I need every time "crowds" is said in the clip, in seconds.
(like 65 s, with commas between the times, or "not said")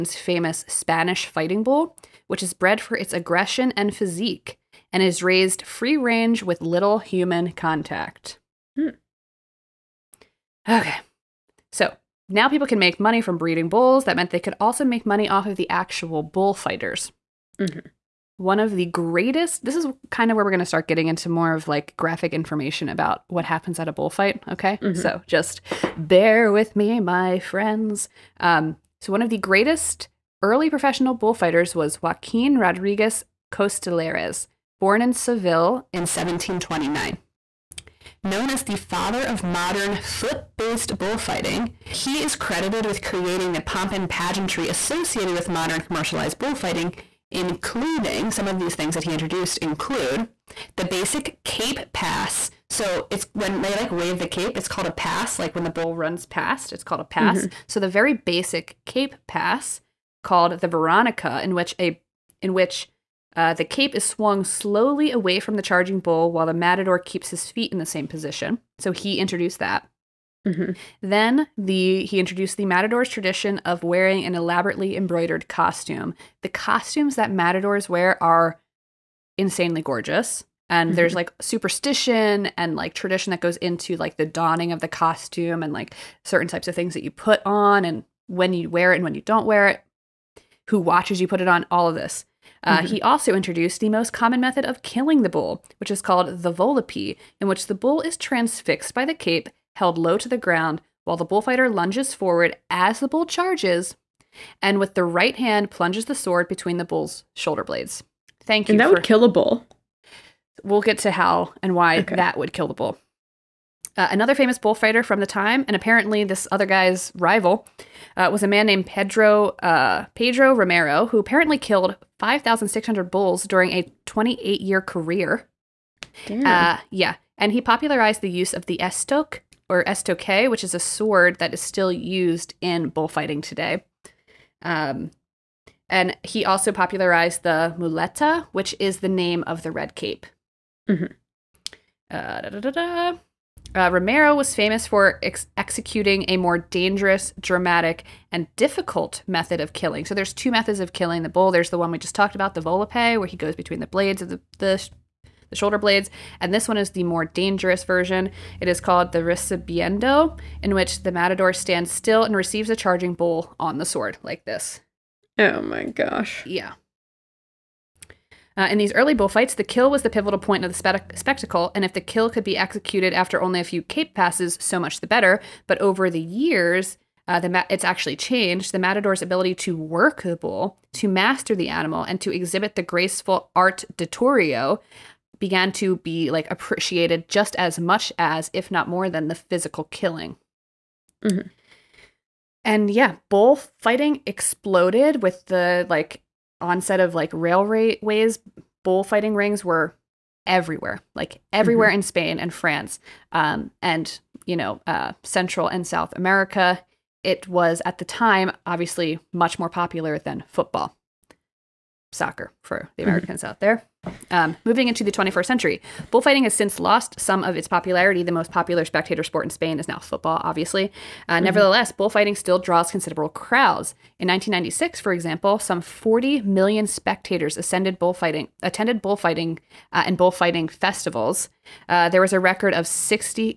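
223 s.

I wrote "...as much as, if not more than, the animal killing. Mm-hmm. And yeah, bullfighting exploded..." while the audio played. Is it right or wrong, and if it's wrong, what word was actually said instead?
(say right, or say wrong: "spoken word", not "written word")
wrong: "physical", not "animal".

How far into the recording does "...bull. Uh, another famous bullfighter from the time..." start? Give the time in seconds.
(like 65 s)
112 s.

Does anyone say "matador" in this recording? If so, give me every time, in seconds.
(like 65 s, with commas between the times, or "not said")
66 s, 72 s, 77 s, 161 s, 178 s.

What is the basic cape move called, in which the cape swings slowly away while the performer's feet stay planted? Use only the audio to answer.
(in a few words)
Veronica.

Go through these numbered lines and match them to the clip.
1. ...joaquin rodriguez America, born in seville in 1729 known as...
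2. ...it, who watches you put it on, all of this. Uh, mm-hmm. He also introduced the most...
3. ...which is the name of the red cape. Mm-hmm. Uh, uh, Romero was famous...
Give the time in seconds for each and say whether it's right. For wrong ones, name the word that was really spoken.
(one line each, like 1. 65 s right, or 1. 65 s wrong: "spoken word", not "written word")
1. 32 s wrong: "Costillares", not "America"
2. 89 s right
3. 138 s right.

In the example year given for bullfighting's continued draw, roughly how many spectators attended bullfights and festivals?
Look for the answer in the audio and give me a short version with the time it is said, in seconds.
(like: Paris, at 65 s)
40 million, at 225 s.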